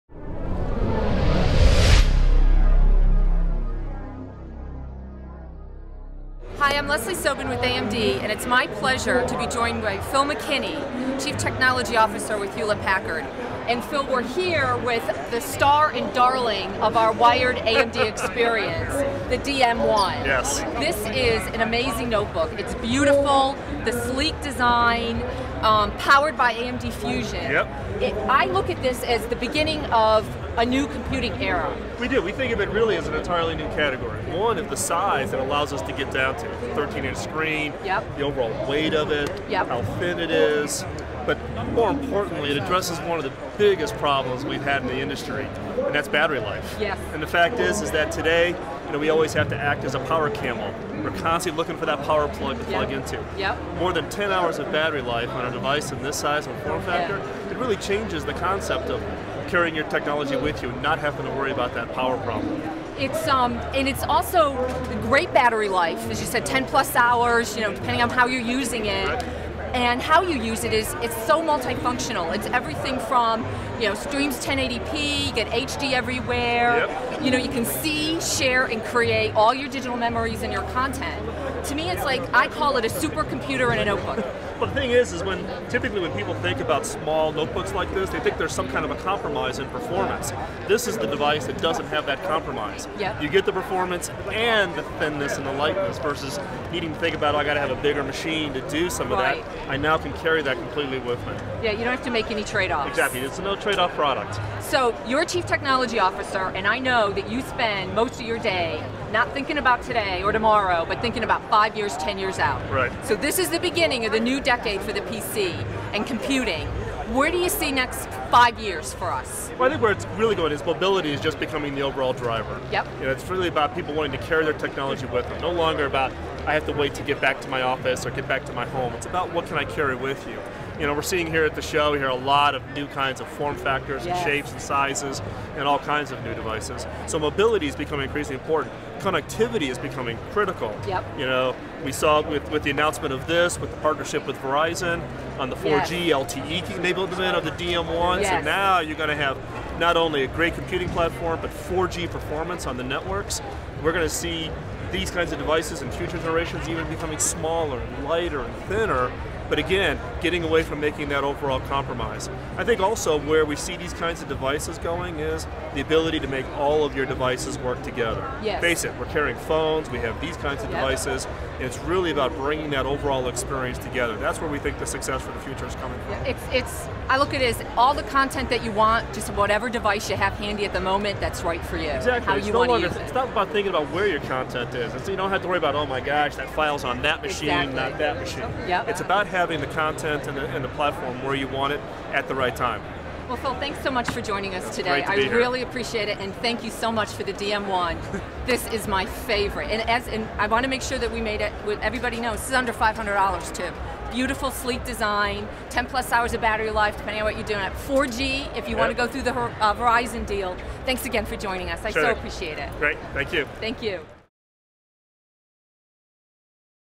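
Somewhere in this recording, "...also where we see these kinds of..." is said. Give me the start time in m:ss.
2:42.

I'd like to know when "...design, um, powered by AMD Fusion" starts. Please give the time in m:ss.
0:24.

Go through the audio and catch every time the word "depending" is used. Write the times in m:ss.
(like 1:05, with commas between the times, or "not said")
1:07, 3:26.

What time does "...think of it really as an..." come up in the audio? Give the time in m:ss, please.
0:32.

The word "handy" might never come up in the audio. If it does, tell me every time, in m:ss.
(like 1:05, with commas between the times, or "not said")
3:00.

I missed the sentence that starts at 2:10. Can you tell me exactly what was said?
You know, we're seeing here at the show, we hear a lot of new kinds of form factors yes.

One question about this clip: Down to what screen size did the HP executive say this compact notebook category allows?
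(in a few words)
13-inch.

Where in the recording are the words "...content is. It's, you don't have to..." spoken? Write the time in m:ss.
3:04.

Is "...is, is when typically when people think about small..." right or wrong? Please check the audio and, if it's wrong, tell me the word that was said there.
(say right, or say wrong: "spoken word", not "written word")
right.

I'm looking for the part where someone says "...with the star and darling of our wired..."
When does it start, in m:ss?
0:14.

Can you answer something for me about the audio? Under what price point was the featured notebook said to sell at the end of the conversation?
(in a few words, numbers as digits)
$500.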